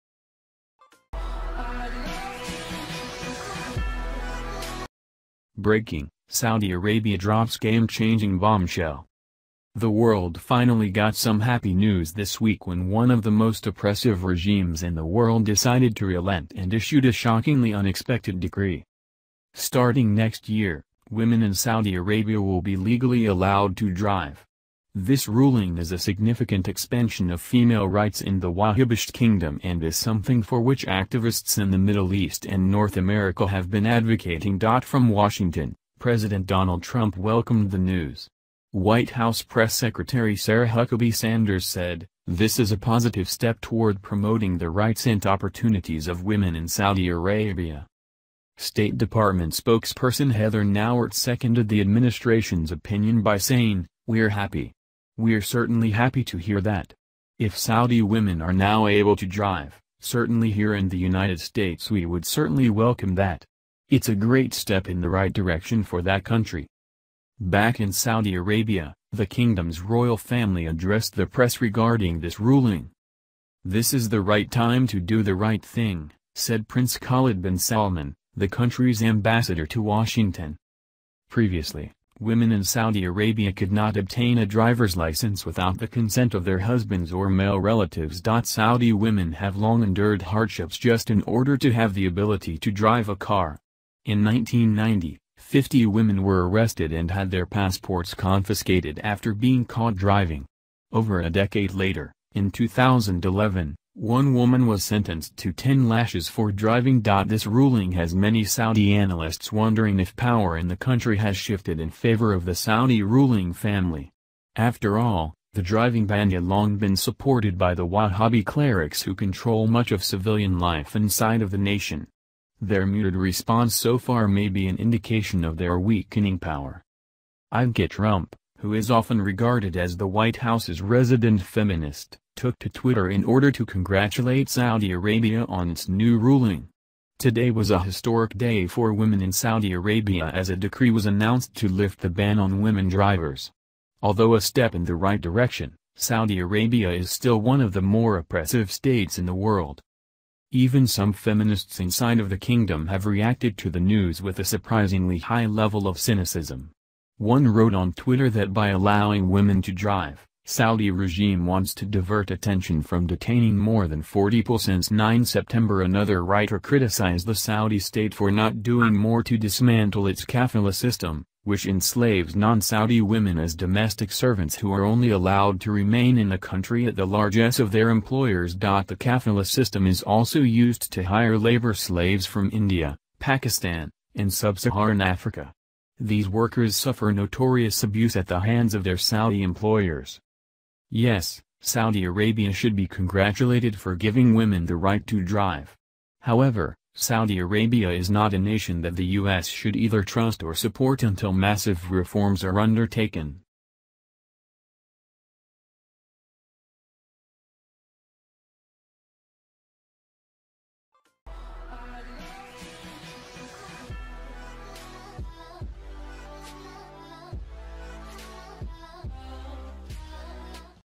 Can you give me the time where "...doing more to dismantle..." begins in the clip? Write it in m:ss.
2:48.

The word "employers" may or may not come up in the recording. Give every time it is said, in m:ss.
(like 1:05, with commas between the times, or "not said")
2:57, 3:09.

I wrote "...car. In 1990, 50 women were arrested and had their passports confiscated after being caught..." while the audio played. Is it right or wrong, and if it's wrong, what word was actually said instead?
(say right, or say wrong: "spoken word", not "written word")
right.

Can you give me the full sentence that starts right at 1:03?
It's a great step in the right direction for that country.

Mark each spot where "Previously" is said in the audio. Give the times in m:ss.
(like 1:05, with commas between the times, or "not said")
1:21.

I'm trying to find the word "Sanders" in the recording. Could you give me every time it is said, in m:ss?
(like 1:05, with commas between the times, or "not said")
0:41.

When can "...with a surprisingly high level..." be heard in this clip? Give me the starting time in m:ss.
2:34.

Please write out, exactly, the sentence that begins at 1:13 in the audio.
This is the right time to do the right thing, said Prince Khalid bin Salman, the country's ambassador to Washington.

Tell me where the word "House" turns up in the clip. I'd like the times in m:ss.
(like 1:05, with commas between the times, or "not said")
0:39, 2:10.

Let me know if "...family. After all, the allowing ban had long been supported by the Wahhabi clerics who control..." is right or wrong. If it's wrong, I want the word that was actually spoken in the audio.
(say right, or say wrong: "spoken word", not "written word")
wrong: "driving", not "allowing".